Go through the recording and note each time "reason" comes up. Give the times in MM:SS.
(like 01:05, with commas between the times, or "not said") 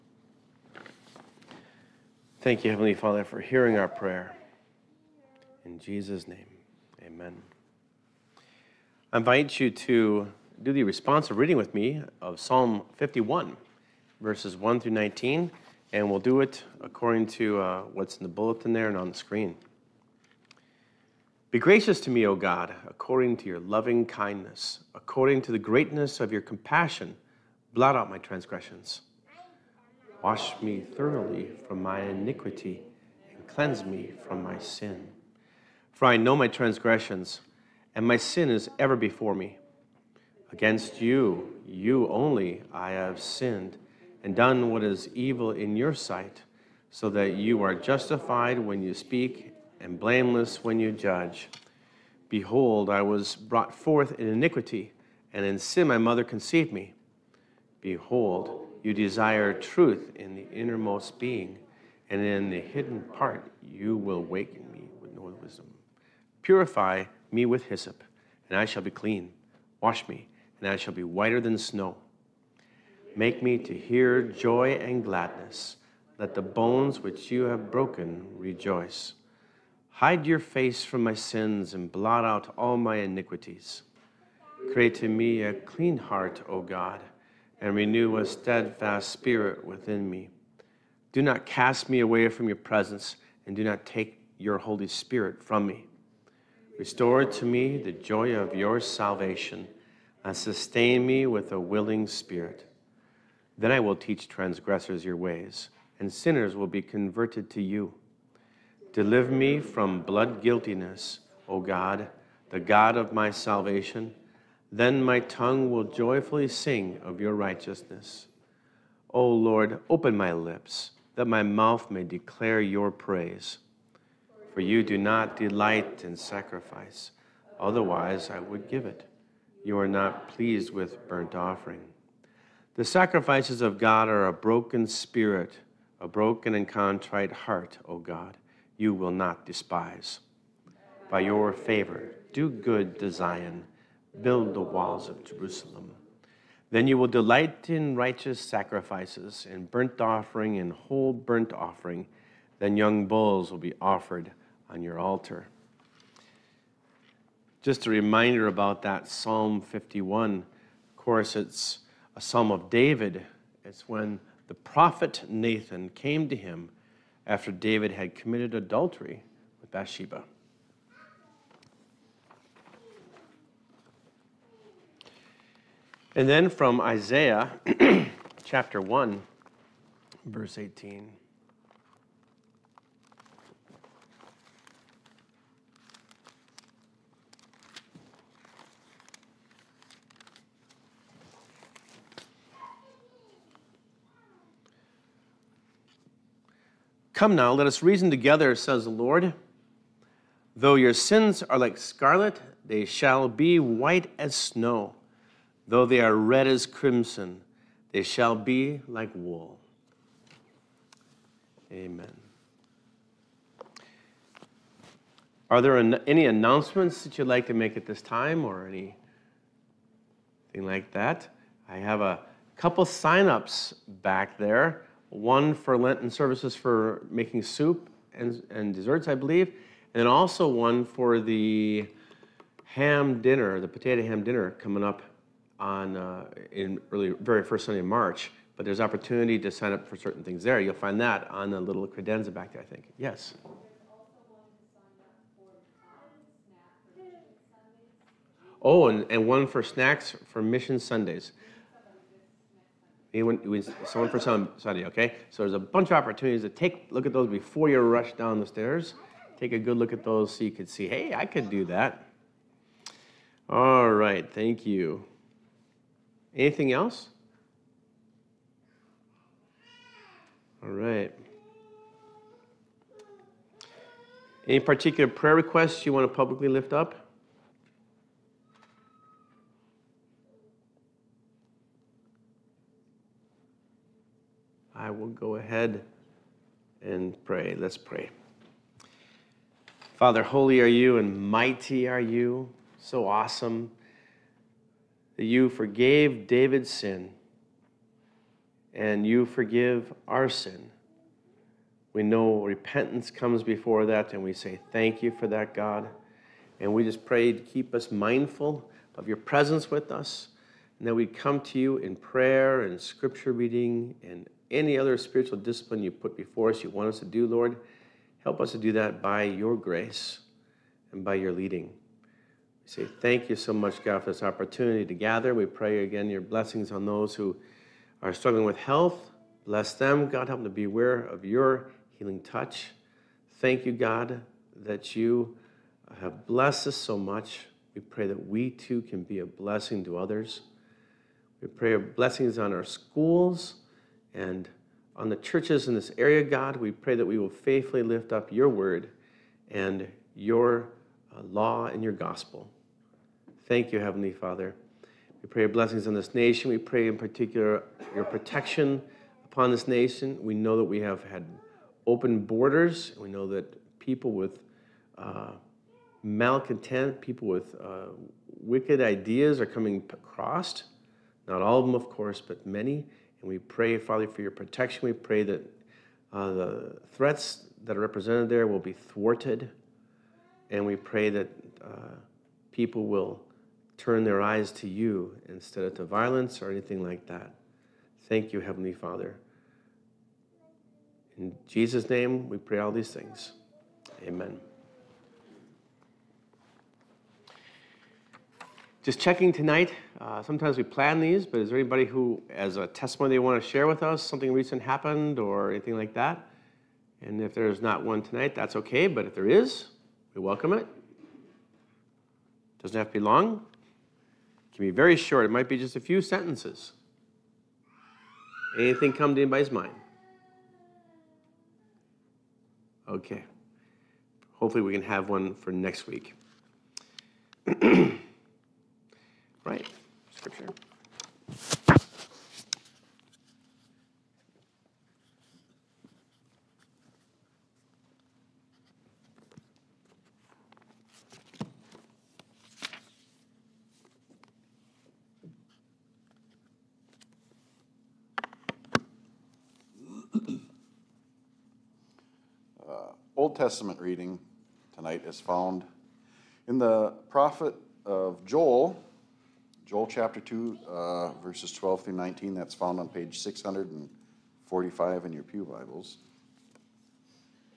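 03:17.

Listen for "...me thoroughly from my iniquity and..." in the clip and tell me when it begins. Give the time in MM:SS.
00:30.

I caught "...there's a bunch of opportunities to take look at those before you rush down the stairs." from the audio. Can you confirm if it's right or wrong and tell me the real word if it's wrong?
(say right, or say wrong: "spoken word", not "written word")
right.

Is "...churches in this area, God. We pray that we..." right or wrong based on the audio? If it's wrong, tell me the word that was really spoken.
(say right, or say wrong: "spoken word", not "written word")
right.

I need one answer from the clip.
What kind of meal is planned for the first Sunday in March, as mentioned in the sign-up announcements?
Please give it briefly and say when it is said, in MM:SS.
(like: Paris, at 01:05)
Potato ham dinner, at 03:53.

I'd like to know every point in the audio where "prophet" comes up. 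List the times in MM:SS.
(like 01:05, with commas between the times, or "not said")
02:44, 07:37.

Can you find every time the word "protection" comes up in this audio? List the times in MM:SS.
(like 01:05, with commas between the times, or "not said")
05:58, 06:14.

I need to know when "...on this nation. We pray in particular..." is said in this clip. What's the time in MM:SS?
05:55.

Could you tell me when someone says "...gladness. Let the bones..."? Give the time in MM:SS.
01:15.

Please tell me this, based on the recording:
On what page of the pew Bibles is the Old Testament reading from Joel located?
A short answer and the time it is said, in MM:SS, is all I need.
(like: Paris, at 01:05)
645, at 07:43.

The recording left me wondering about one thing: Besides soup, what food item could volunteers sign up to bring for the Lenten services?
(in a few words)
Desserts.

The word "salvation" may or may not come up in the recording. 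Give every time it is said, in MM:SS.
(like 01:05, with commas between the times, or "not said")
01:38, 01:53.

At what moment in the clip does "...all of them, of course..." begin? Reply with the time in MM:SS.
06:11.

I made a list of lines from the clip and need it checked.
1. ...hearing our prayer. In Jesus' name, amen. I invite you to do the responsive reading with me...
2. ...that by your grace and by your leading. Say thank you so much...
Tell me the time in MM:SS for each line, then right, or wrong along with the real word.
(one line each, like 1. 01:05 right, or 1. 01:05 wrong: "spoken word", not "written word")
1. 00:03 right
2. 05:18 right.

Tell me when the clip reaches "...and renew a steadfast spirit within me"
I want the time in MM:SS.
01:27.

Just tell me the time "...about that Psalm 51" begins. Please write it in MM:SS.
02:38.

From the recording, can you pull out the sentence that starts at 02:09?
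You are not pleased with burnt offering.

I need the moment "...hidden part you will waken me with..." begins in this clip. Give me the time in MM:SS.
01:02.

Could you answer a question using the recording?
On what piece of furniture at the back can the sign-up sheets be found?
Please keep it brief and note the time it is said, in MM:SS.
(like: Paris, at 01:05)
Credenza, at 04:01.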